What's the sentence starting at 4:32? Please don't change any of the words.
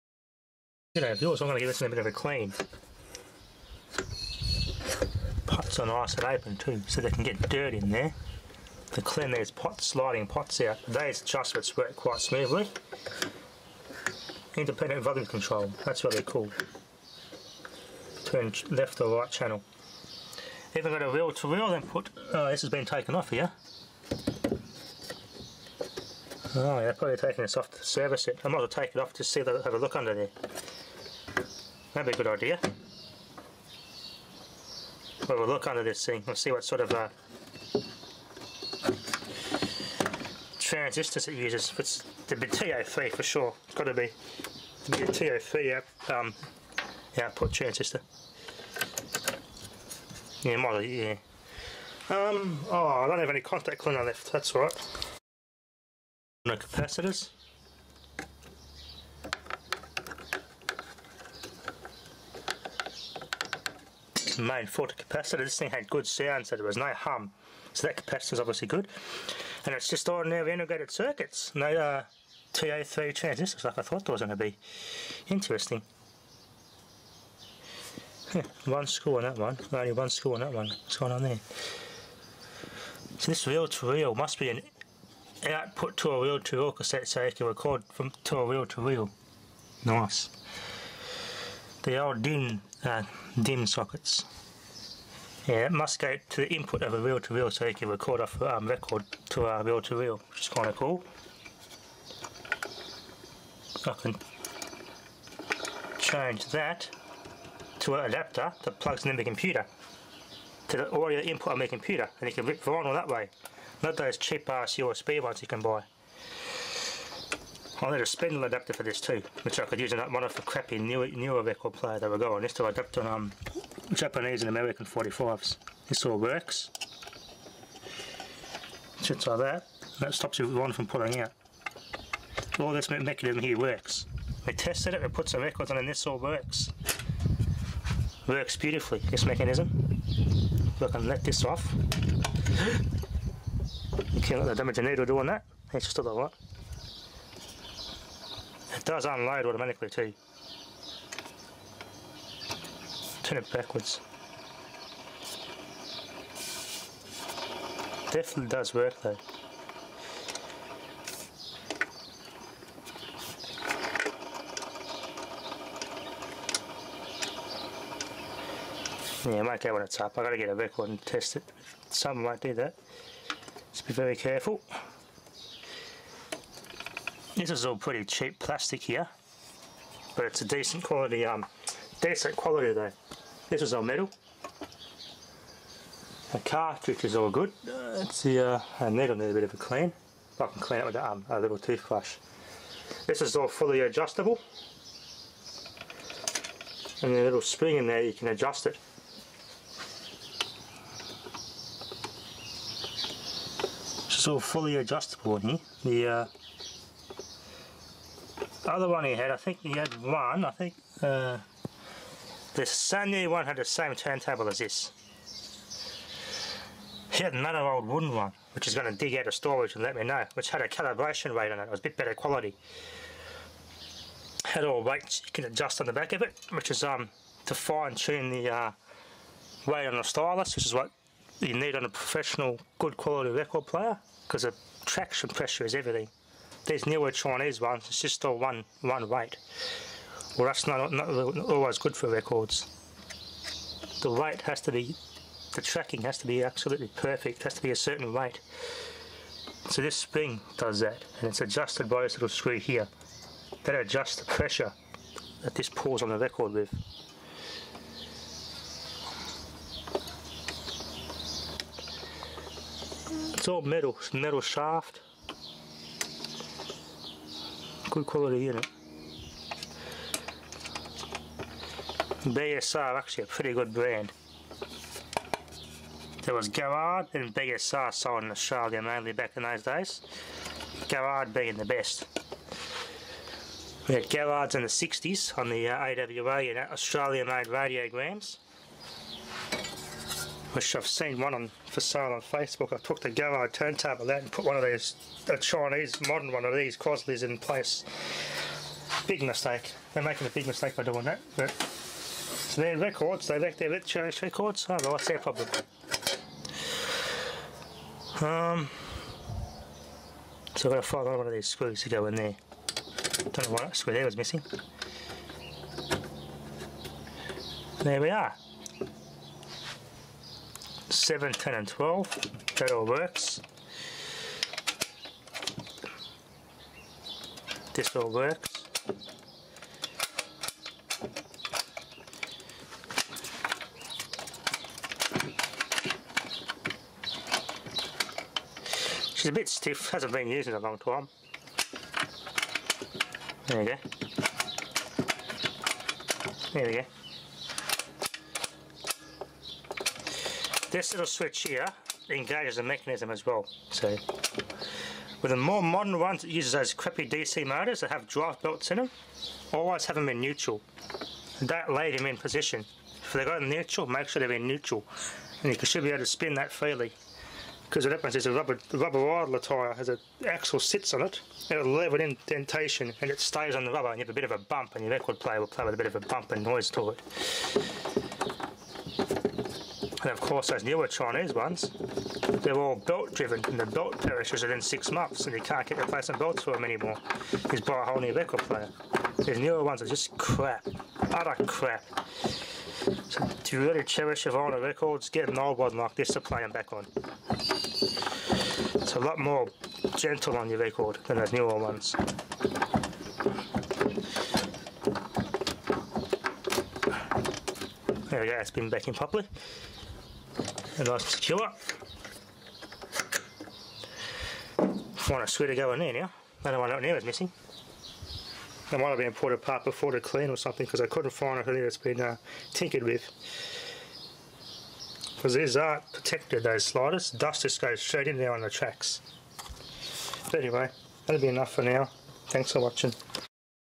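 BSR actually a pretty good brand.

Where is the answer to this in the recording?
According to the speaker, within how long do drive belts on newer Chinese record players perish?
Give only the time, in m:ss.
6:24.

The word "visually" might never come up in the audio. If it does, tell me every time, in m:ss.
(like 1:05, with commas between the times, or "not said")
not said.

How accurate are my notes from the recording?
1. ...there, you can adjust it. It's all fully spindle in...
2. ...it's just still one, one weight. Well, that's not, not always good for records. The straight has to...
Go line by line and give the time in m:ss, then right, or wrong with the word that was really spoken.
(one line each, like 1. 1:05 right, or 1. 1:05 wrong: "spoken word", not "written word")
1. 3:17 wrong: "adjustable", not "spindle"
2. 3:57 wrong: "weight", not "straight".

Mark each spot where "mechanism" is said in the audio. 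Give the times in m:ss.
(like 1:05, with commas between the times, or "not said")
2:12, 2:19, 5:52.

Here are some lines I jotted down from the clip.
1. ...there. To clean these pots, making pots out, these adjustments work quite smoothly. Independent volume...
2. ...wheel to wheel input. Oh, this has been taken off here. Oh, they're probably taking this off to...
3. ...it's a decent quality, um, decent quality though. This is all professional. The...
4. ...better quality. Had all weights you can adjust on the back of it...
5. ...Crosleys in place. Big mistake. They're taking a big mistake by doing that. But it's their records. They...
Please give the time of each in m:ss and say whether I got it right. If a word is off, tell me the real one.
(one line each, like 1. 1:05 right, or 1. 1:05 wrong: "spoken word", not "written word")
1. 0:07 wrong: "sliding", not "making"
2. 0:21 right
3. 3:00 wrong: "metal", not "professional"
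4. 3:41 right
5. 4:56 wrong: "making", not "taking".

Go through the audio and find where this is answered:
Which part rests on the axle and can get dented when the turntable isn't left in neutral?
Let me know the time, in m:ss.
6:08.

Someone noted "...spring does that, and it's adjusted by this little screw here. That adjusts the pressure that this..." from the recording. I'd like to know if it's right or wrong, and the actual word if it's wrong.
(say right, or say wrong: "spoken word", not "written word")
right.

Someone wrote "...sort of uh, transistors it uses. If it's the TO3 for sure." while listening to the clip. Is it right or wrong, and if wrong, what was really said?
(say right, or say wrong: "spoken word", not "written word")
right.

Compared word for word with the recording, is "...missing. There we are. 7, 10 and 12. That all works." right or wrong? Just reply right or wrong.
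right.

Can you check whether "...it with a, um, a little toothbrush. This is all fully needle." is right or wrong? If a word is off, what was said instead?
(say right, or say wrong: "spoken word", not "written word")
wrong: "adjustable", not "needle".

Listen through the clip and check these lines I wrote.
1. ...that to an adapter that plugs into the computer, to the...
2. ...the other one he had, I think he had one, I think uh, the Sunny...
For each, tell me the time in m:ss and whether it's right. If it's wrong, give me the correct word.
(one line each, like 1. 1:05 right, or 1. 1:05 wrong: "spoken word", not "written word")
1. 1:46 right
2. 3:28 right.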